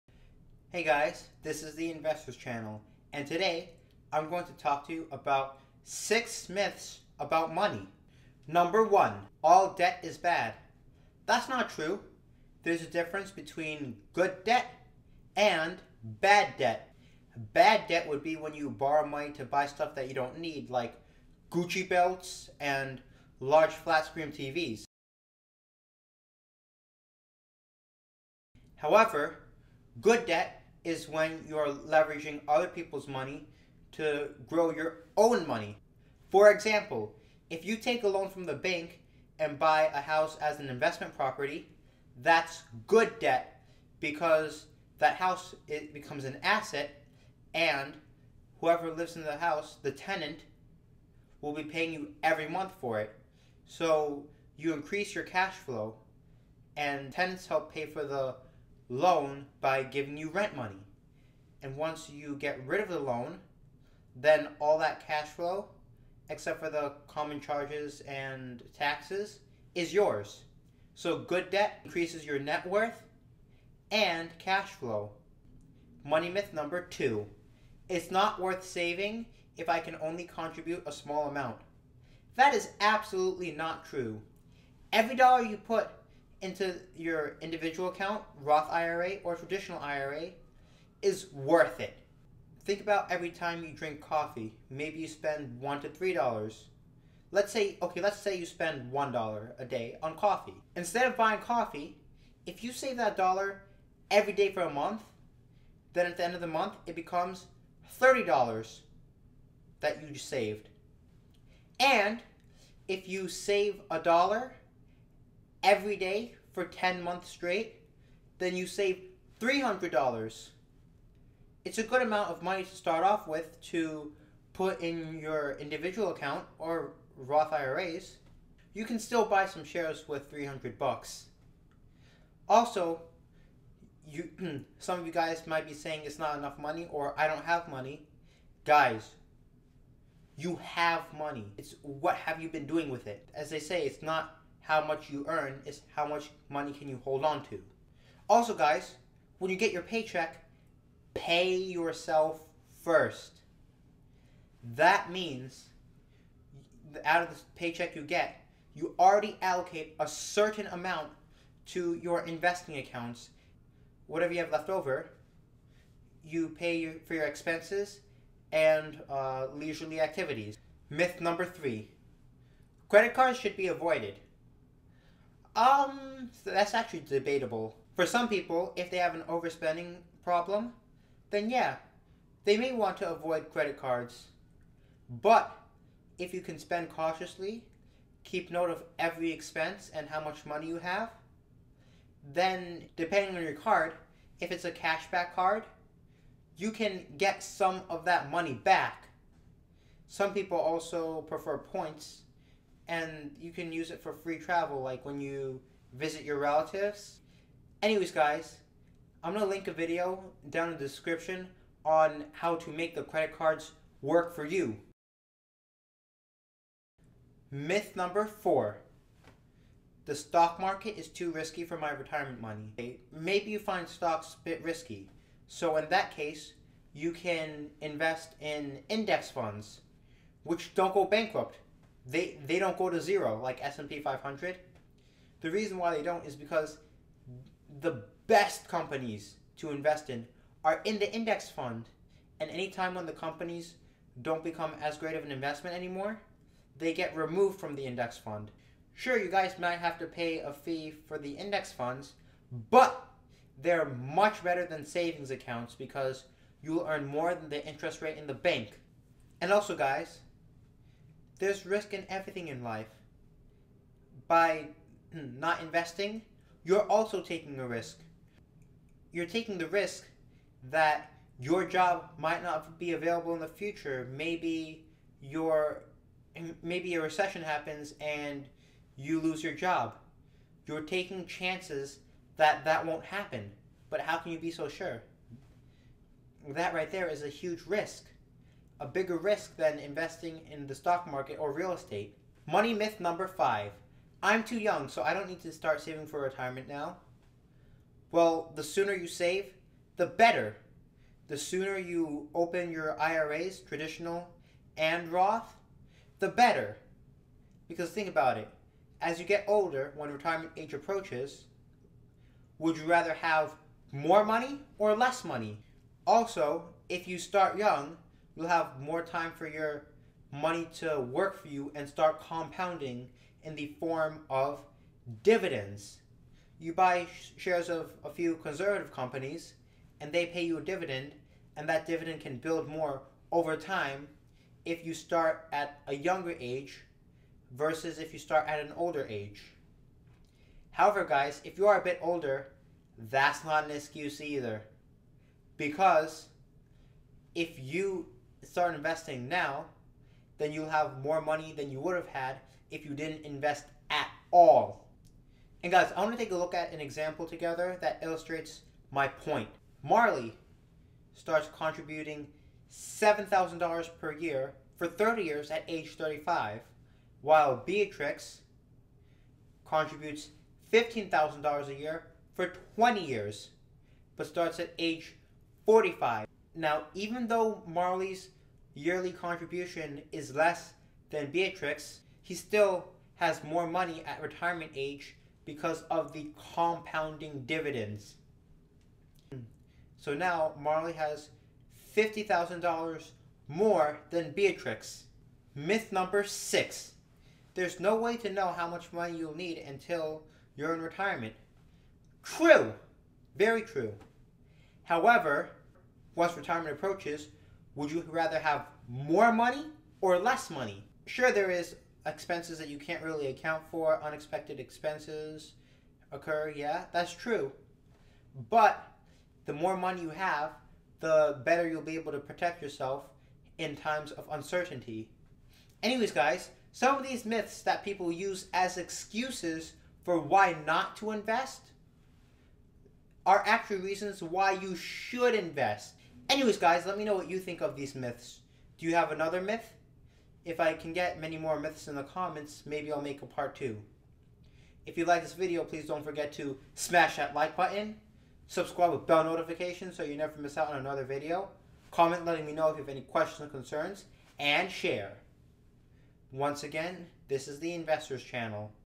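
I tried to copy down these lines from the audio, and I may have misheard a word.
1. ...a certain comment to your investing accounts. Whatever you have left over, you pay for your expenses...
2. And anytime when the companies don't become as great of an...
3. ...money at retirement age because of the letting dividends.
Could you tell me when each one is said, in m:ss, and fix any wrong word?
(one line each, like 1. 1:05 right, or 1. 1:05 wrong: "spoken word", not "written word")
1. 2:39 wrong: "amount", not "comment"
2. 4:02 right
3. 6:23 wrong: "compounding", not "letting".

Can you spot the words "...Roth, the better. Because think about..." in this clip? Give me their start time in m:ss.
5:05.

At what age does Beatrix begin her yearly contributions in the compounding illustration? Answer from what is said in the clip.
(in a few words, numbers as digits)
45.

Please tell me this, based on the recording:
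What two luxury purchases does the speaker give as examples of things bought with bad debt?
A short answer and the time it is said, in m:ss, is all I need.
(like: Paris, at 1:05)
Gucci belts and large flat screen TVs, at 0:21.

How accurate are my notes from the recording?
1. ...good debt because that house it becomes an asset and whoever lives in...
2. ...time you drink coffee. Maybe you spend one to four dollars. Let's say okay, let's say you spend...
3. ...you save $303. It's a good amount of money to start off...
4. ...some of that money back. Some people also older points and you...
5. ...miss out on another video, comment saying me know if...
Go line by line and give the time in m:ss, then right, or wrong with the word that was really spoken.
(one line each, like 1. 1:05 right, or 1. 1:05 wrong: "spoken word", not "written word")
1. 0:42 right
2. 1:33 wrong: "three", not "four"
3. 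1:58 wrong: "300", not "303"
4. 3:17 wrong: "prefer", not "older"
5. 7:30 wrong: "letting", not "saying".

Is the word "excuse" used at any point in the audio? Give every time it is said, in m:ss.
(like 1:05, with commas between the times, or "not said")
5:43, 7:08.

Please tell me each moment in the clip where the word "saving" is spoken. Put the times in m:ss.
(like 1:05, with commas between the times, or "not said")
1:18, 4:14, 4:55.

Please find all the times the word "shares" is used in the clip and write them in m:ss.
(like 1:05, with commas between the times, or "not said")
2:09, 5:27, 7:34.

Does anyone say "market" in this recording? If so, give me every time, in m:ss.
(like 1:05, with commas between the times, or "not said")
3:40, 4:51.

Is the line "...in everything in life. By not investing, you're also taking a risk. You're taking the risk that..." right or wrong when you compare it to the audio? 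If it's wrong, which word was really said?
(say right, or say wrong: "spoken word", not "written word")
right.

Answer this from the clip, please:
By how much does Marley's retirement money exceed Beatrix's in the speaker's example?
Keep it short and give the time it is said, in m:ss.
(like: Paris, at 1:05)
$50,000, at 6:31.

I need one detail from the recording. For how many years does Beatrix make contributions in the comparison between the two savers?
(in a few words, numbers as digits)
20.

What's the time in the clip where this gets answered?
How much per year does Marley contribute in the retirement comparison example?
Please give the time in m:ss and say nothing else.
6:02.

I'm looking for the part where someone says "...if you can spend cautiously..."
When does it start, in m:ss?
3:06.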